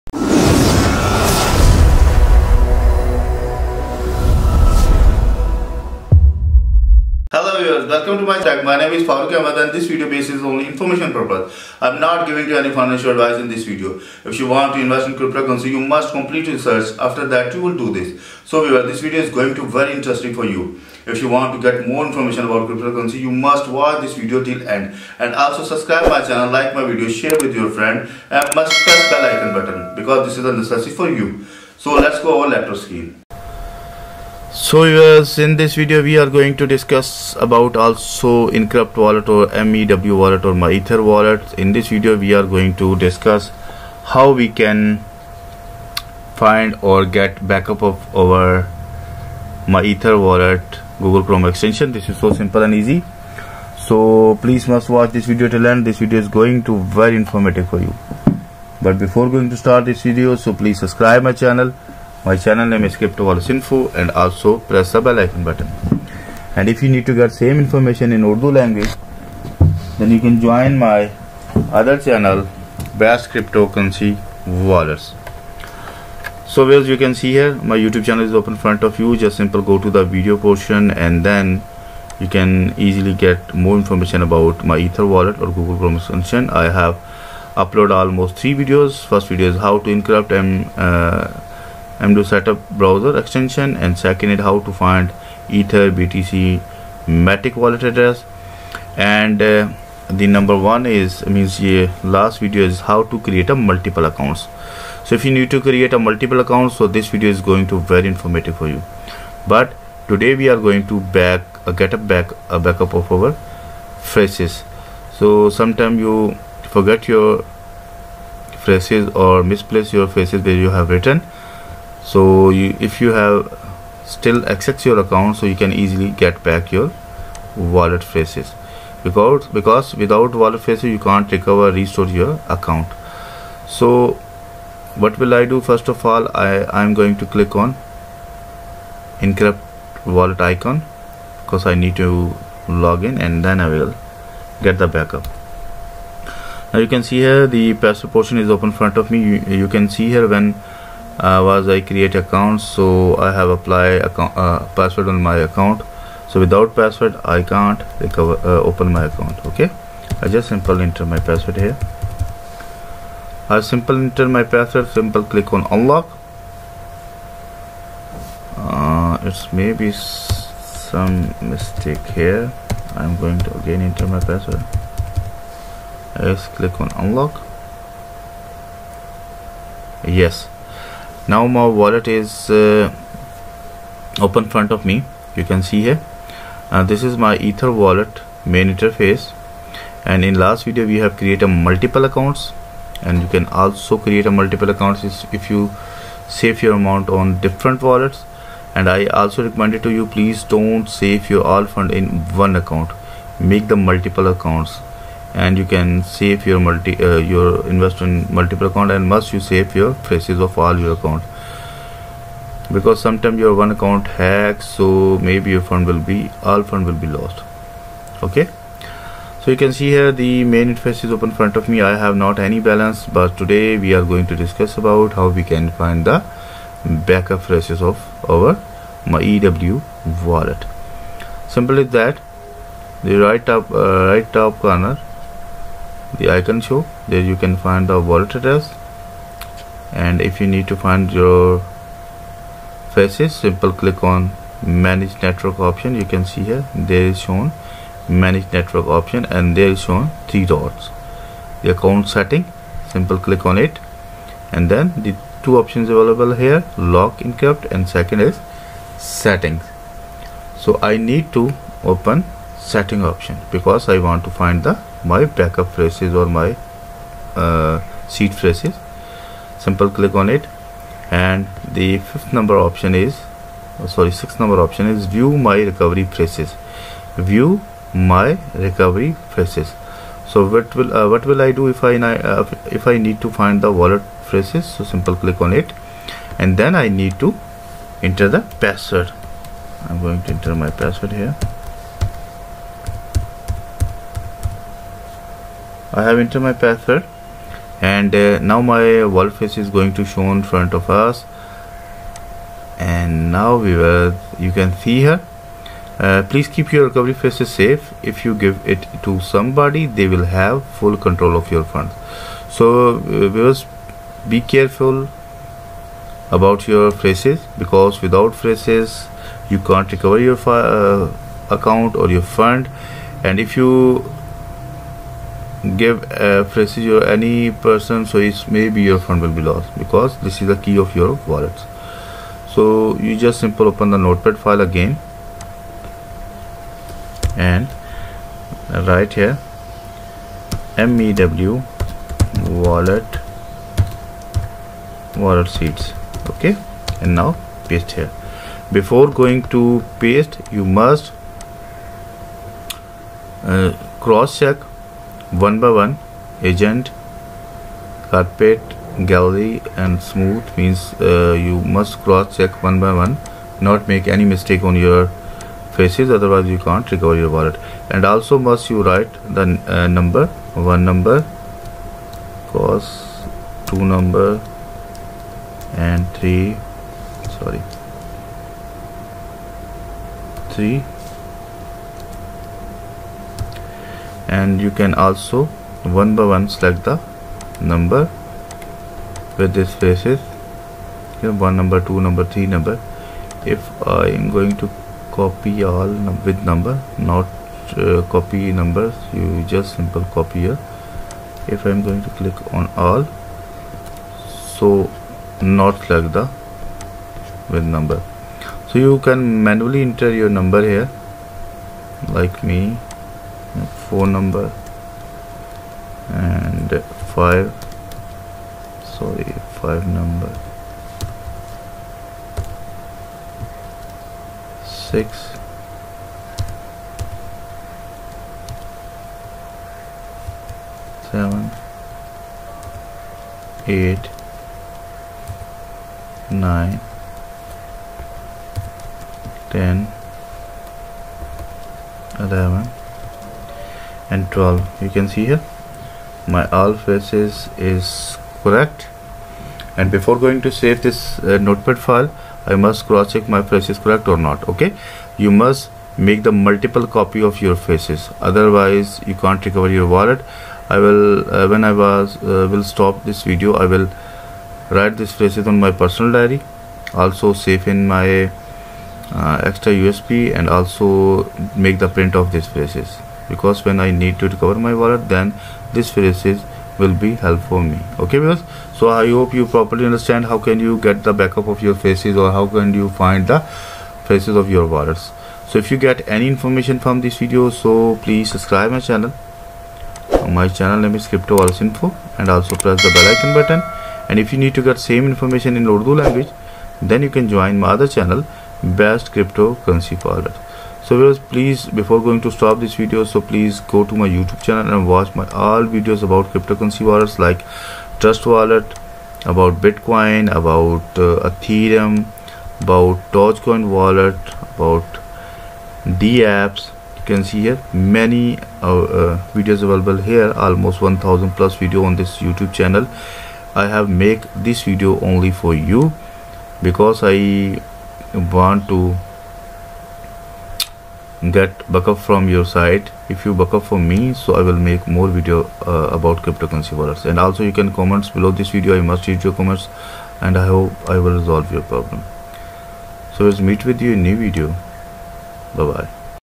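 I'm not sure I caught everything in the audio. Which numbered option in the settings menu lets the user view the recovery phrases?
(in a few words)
6.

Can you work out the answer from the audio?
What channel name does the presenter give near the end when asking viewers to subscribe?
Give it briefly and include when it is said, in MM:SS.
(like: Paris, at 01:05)
Crypto Wallets Info, at 08:11.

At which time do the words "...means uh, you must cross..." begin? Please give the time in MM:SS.
06:00.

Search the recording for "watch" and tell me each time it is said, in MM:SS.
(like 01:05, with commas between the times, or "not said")
00:23, 00:54, 08:24.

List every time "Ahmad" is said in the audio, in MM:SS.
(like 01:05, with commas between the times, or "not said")
00:09.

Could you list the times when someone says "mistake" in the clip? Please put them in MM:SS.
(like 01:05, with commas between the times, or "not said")
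02:51, 06:04.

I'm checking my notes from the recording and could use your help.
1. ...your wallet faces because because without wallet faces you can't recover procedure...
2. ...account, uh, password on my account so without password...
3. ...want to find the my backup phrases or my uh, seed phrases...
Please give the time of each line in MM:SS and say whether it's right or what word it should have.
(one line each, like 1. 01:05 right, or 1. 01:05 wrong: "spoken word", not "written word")
1. 02:06 wrong: "restore", not "procedure"
2. 02:34 right
3. 04:23 right.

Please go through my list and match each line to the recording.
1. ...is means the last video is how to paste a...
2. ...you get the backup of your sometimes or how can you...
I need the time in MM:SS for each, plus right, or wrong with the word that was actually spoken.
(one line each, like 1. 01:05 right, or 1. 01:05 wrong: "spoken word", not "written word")
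1. 01:40 wrong: "create", not "paste"
2. 08:00 wrong: "faces", not "sometimes".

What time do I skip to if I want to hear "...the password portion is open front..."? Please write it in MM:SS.
02:27.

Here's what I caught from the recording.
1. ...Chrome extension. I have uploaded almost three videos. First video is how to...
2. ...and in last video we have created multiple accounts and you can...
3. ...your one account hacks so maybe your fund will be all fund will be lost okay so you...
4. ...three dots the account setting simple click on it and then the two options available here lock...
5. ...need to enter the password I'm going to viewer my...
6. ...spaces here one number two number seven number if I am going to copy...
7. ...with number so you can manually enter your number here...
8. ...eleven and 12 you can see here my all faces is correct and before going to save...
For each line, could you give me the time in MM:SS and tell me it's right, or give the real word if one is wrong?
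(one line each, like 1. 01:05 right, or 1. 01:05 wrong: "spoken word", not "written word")
1. 01:25 right
2. 03:10 right
3. 03:33 right
4. 04:10 right
5. 04:46 wrong: "enter", not "viewer"
6. 06:29 wrong: "three", not "seven"
7. 06:47 right
8. 07:22 right.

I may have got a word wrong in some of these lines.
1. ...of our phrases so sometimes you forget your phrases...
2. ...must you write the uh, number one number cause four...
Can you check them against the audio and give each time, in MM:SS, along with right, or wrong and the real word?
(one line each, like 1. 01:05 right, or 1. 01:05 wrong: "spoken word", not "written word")
1. 01:52 right
2. 06:08 wrong: "two", not "four".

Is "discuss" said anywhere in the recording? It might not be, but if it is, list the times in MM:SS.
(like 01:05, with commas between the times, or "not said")
00:36, 00:42, 03:44.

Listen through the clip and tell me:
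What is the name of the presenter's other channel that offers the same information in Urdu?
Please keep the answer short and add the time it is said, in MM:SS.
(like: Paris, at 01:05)
Best Cryptocurrency Wallets, at 01:12.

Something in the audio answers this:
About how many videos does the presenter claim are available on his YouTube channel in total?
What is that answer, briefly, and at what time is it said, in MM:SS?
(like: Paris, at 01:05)
1000+, at 08:40.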